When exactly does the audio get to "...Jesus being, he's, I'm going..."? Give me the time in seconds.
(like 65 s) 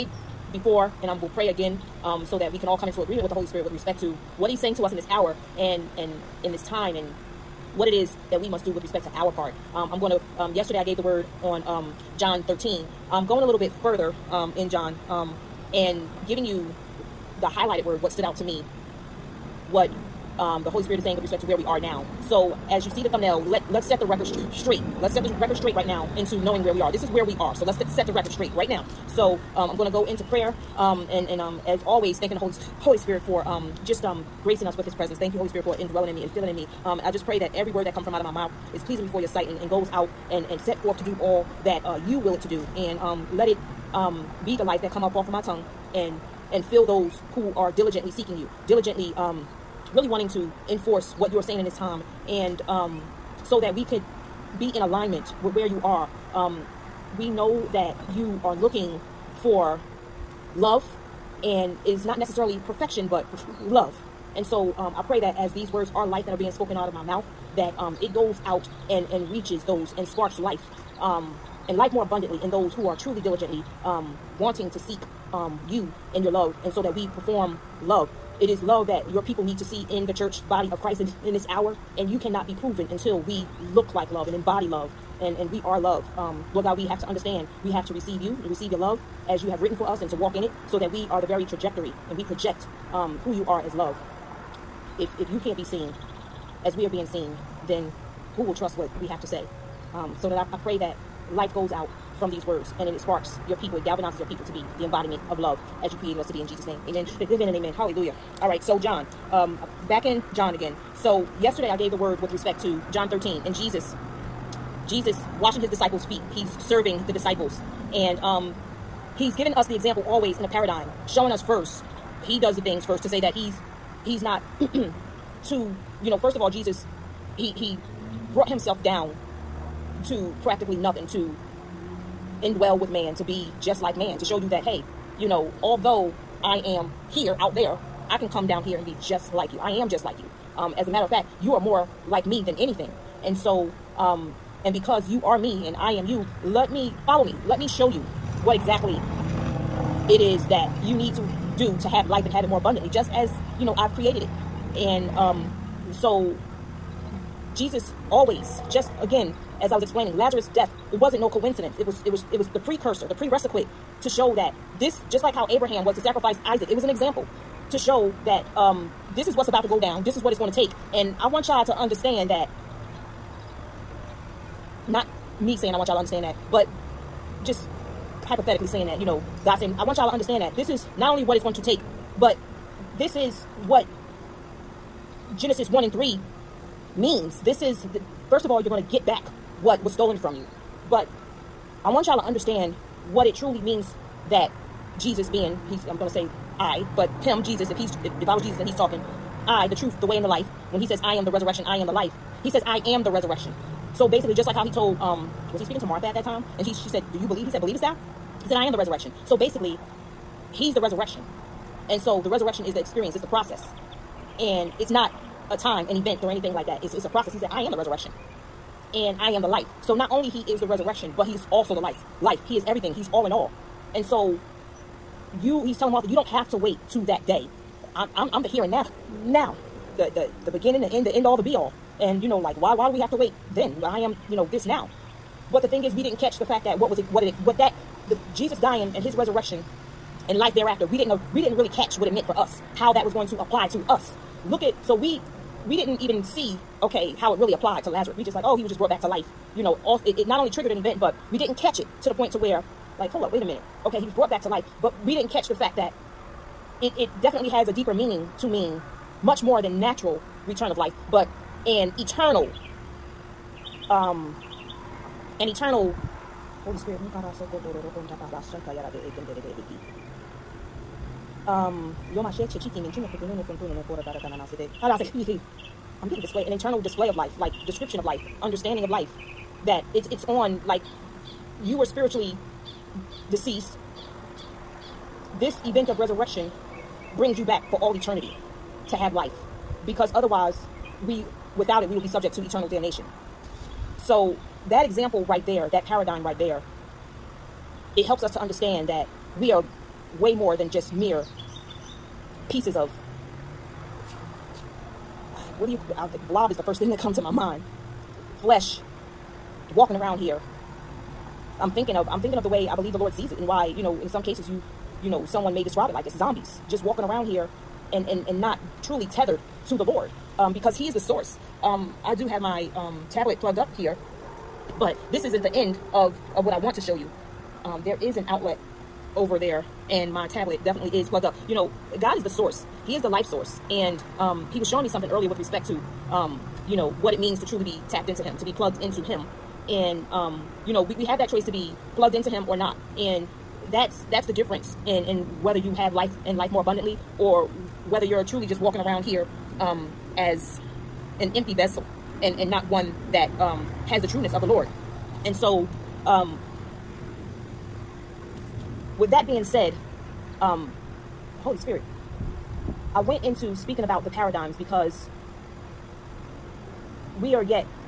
194 s.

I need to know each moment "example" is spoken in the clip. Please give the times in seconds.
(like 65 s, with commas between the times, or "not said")
119 s, 166 s, 294 s.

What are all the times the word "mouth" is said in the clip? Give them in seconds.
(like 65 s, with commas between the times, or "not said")
38 s, 67 s.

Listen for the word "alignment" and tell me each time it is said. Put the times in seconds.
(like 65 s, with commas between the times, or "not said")
54 s.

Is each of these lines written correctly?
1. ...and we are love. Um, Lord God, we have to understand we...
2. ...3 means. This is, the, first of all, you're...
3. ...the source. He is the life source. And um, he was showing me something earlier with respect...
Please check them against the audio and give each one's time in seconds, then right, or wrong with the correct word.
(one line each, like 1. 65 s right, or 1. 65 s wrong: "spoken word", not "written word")
1. 85 s right
2. 185 s right
3. 332 s right.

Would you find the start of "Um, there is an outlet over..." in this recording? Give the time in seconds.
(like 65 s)
327 s.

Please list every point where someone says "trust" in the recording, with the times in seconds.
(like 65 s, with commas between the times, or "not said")
98 s.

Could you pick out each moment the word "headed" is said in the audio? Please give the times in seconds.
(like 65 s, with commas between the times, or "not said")
not said.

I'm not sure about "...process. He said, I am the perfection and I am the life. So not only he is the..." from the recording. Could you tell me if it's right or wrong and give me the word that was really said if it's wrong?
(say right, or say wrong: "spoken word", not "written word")
wrong: "resurrection", not "perfection".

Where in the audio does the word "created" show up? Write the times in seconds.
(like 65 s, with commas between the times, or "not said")
106 s, 153 s.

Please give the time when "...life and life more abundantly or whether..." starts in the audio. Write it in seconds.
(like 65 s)
345 s.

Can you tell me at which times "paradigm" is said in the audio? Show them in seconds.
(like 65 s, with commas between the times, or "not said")
120 s, 295 s, 364 s.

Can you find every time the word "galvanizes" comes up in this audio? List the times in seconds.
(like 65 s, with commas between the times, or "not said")
103 s.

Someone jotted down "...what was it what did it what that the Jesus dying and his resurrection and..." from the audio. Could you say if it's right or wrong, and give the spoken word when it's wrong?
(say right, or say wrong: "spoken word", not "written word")
right.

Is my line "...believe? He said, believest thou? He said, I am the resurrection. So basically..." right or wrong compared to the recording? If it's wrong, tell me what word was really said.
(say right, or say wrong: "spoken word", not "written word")
right.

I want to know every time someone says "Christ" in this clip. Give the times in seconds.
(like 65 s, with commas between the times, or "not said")
80 s.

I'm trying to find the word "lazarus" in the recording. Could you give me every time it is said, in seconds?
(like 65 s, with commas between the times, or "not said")
160 s, 247 s.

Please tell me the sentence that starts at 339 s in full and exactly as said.
And, um, you know, we, we had that choice to be plugged into Him or not.